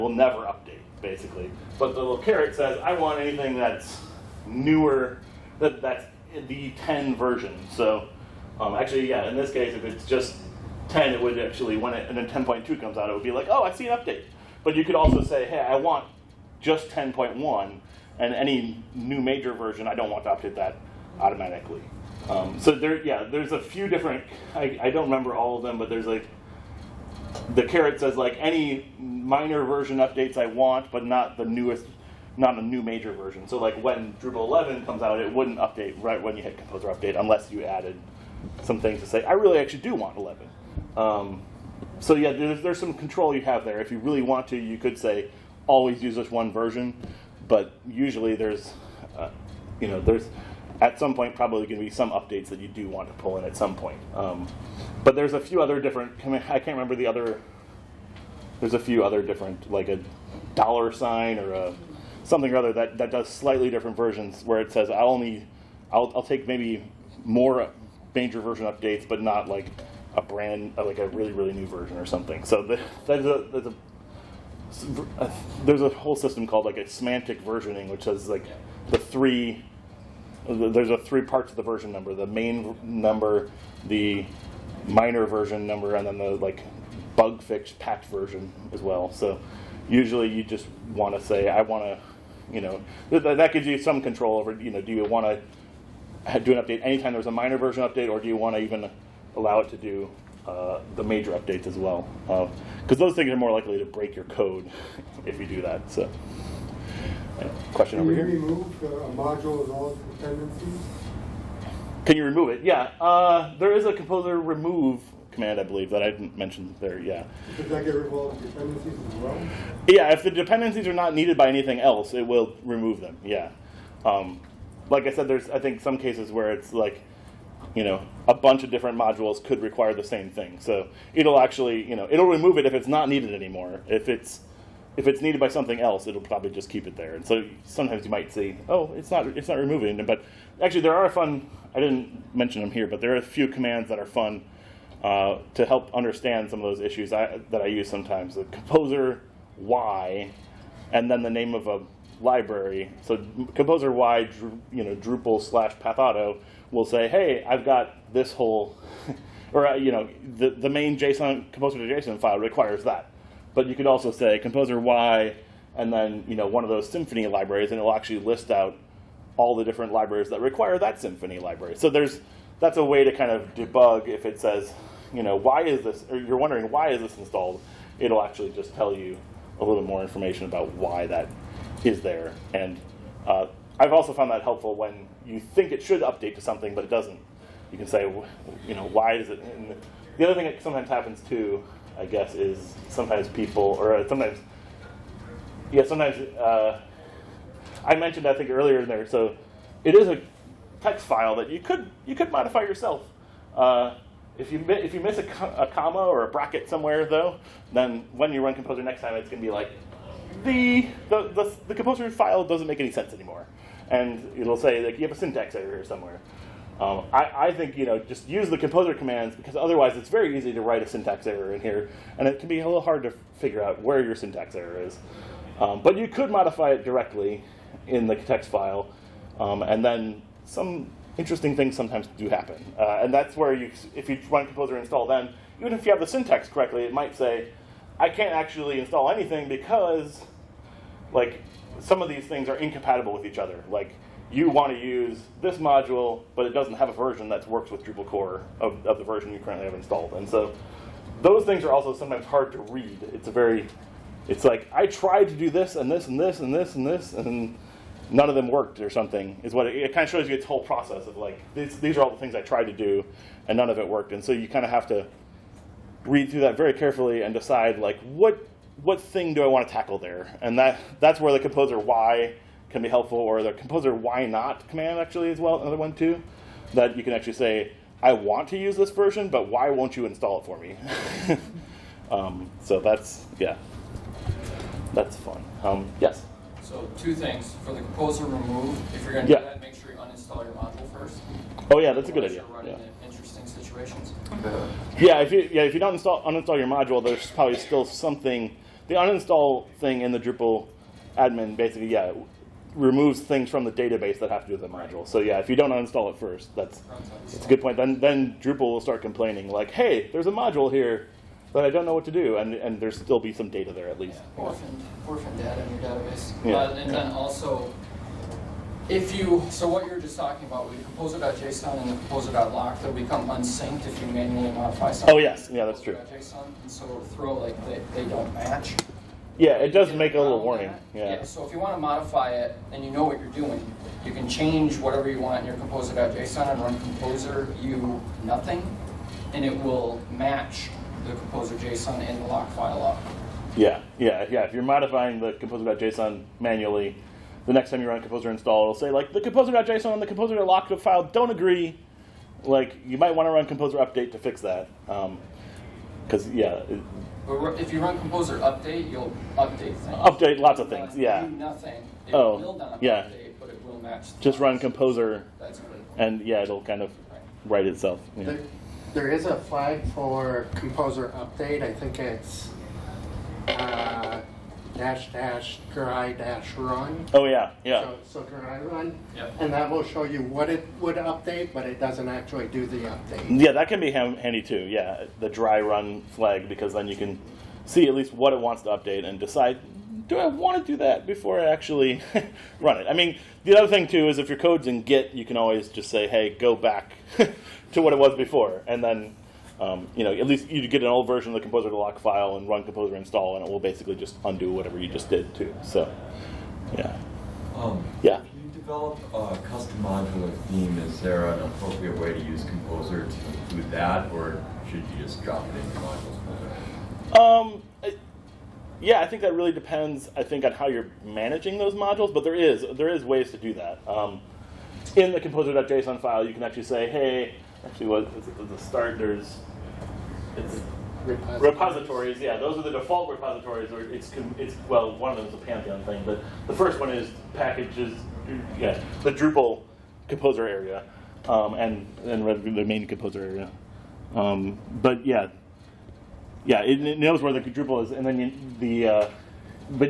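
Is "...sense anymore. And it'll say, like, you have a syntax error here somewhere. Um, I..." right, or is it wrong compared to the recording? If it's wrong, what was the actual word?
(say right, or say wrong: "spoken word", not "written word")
right.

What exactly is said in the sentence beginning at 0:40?
Um, so yeah, there's, there's some control you have there.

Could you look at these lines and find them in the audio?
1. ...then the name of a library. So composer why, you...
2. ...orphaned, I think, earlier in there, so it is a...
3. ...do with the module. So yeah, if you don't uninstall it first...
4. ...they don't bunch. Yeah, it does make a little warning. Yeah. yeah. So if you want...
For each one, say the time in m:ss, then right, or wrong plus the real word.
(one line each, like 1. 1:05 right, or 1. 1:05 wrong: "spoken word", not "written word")
1. 2:31 right
2. 3:17 wrong: "mentioned", not "orphaned"
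3. 5:04 right
4. 5:27 wrong: "match", not "bunch".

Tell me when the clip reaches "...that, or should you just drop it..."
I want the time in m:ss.
6:53.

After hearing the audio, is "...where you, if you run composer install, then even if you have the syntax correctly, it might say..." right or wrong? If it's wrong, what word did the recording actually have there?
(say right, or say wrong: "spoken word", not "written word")
right.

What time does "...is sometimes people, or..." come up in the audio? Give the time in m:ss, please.
3:12.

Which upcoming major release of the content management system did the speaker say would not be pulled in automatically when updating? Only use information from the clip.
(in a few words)
Drupal 11.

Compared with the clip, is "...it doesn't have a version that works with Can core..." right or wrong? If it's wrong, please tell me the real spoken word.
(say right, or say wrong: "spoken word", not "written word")
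wrong: "Drupal", not "Can".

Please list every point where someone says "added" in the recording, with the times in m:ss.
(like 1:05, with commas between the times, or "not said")
0:37.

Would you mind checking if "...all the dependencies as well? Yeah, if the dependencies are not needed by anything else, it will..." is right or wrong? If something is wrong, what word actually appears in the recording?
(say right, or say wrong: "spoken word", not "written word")
right.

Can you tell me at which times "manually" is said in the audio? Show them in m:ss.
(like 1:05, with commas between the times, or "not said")
5:24, 5:46.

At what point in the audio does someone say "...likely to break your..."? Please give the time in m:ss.
1:43.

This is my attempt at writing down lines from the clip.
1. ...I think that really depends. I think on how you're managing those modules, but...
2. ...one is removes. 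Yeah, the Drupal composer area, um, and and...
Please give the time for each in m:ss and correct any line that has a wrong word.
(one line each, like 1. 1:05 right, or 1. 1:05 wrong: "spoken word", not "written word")
1. 6:58 right
2. 7:16 wrong: "packages", not "removes".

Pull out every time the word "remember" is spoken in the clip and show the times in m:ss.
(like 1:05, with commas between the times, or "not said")
0:25, 0:56.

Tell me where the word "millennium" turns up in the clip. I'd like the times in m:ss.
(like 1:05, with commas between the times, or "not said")
not said.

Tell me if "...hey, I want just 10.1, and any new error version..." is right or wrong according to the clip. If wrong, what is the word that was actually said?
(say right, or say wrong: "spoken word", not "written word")
wrong: "major", not "error".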